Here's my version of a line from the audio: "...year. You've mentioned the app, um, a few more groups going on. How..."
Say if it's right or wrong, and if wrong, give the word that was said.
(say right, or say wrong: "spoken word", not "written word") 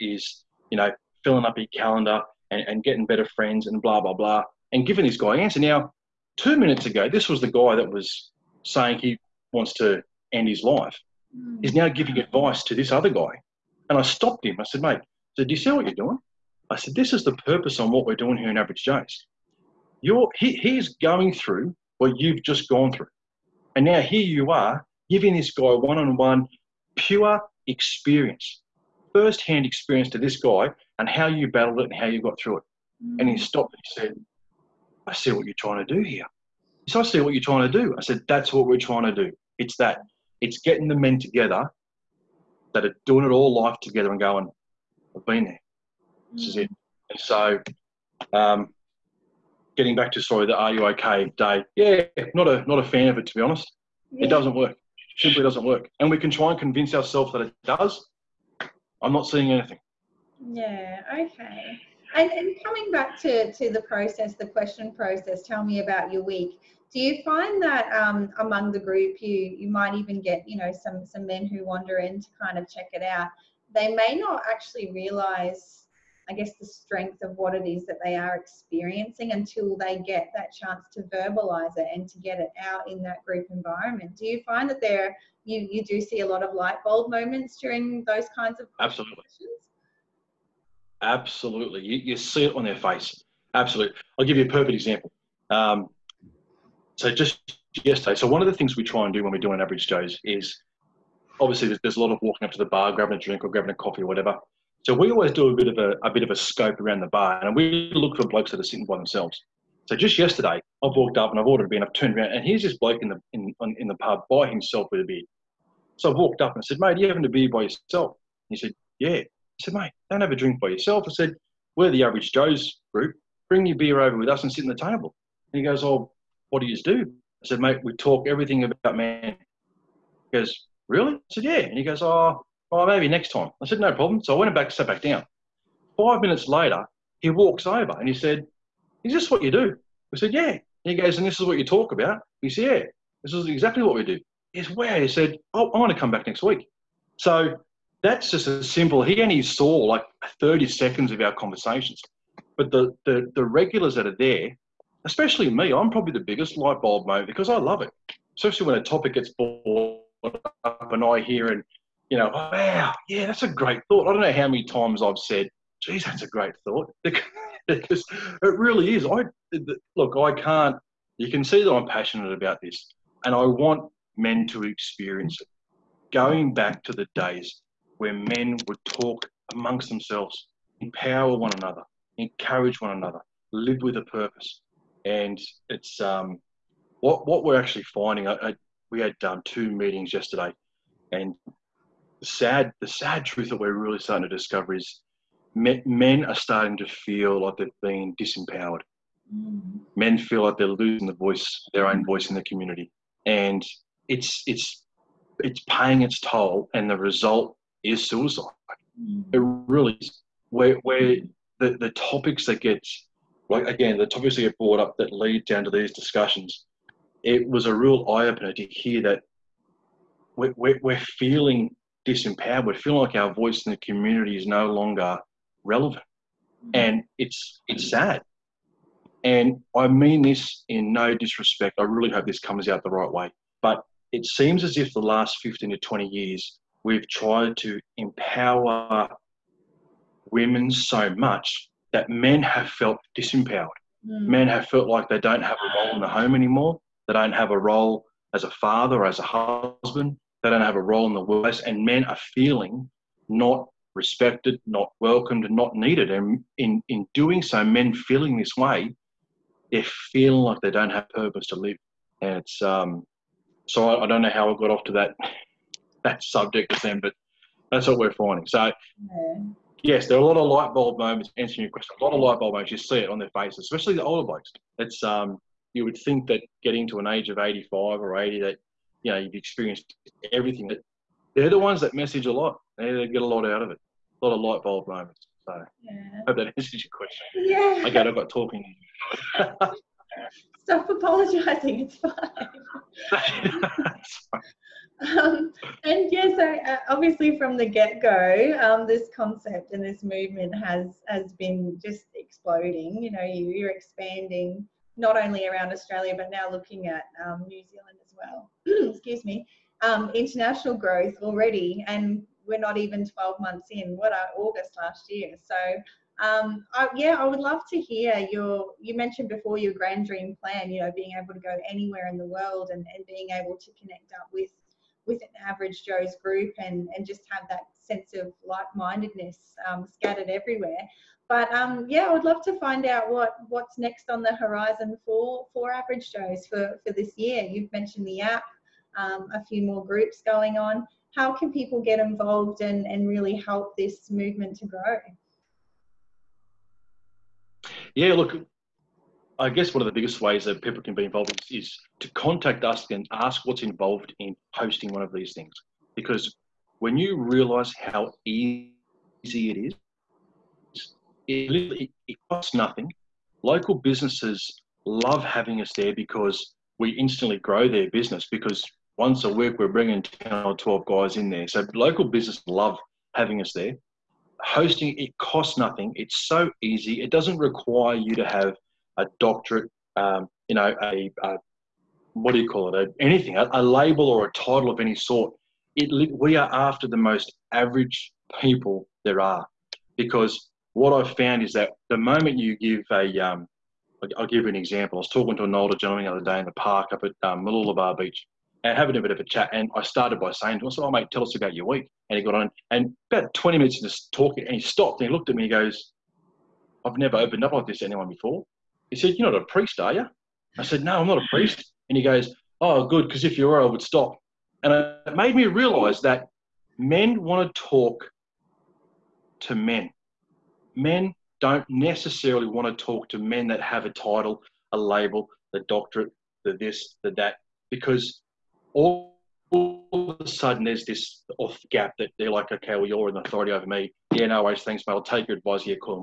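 right.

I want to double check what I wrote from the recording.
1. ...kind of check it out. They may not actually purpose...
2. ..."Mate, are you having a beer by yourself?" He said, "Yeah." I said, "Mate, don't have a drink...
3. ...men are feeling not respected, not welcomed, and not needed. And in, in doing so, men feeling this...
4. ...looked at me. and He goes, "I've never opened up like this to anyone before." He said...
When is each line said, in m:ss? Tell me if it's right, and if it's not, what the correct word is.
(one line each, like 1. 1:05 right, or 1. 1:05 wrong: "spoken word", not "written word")
1. 1:12 wrong: "realise", not "purpose"
2. 1:56 right
3. 4:11 right
4. 6:45 right.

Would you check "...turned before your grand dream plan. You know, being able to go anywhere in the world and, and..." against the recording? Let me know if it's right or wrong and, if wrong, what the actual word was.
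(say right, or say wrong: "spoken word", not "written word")
wrong: "mentioned", not "turned".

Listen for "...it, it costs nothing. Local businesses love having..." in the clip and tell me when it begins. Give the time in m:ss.
6:01.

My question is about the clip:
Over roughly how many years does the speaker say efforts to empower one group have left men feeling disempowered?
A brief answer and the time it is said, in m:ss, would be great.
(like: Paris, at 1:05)
15 to 20 years, at 3:55.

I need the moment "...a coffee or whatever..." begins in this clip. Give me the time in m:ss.
1:43.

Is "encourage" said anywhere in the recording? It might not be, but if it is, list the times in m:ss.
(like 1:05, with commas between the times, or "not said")
3:02.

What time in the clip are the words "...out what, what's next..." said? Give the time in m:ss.
5:32.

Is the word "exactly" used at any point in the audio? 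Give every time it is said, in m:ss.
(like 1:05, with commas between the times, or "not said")
2:23.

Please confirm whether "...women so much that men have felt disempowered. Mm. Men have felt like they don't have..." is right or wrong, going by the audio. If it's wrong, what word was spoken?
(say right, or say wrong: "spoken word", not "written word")
right.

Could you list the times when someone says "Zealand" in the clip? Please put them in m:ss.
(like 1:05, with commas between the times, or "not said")
5:07.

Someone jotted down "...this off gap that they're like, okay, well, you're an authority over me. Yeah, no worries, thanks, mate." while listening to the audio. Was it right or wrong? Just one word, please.
right.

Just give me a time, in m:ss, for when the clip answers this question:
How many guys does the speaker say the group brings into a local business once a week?
6:10.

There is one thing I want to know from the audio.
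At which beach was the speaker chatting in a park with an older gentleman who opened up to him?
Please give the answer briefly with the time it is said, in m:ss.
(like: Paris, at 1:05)
Mooloolaba Beach, at 6:37.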